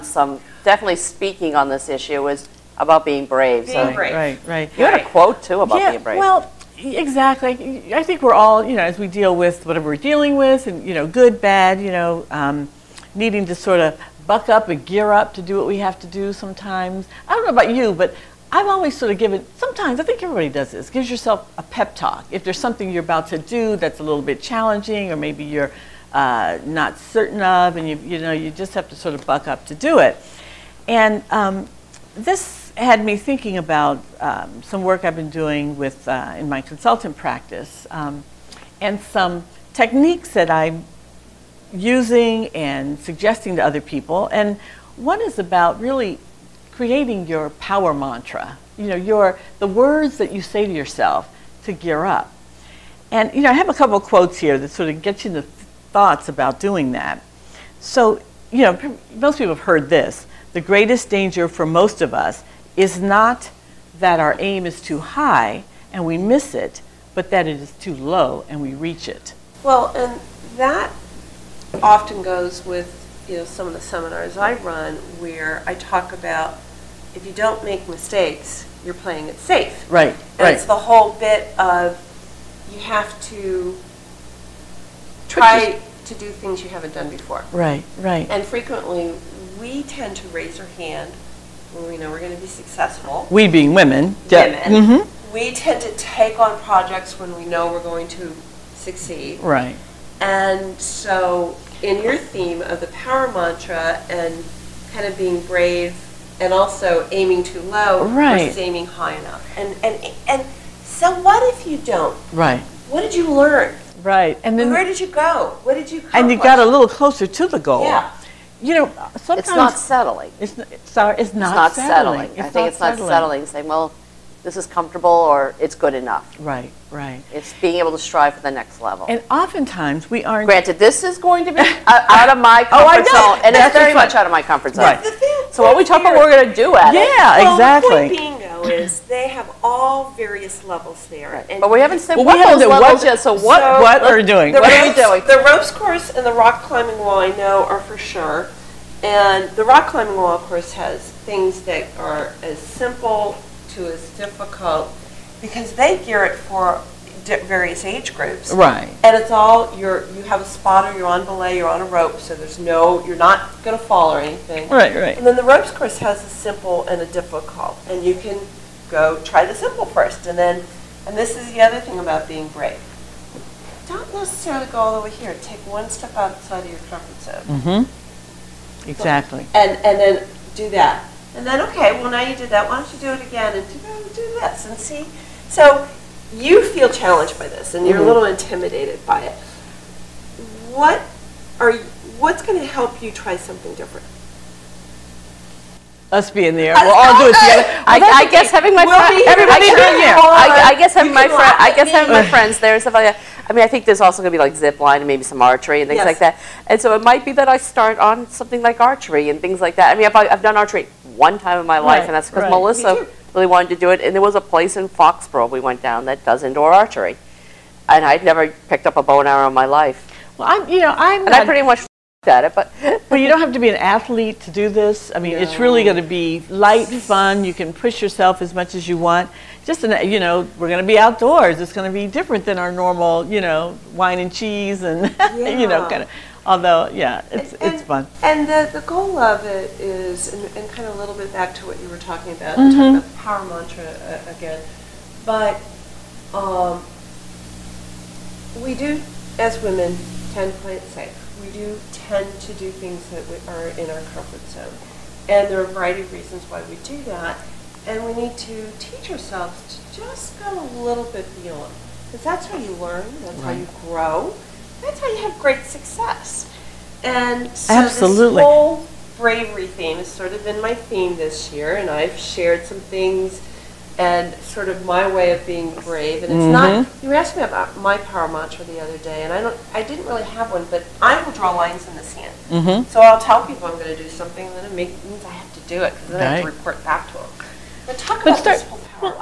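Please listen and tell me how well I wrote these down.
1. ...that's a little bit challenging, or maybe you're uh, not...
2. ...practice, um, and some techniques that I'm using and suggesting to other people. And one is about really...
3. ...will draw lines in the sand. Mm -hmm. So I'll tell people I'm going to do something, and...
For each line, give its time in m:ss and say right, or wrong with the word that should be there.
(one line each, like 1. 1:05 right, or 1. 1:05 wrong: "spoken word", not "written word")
1. 0:23 right
2. 0:37 right
3. 4:41 right.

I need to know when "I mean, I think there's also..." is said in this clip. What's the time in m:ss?
3:23.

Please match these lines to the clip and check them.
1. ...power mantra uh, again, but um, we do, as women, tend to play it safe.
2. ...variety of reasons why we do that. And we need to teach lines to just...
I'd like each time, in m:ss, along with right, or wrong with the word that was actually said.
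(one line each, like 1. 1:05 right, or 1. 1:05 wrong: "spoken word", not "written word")
1. 4:03 right
2. 4:15 wrong: "ourselves", not "lines".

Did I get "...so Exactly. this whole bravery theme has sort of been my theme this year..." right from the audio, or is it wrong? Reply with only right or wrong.
wrong.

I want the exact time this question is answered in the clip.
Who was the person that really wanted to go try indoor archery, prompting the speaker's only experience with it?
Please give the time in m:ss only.
3:32.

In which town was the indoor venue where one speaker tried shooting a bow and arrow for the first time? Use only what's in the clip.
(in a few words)
Foxborough.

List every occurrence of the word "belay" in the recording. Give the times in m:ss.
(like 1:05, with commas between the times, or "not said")
2:41.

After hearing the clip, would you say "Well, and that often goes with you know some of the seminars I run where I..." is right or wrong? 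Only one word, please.
right.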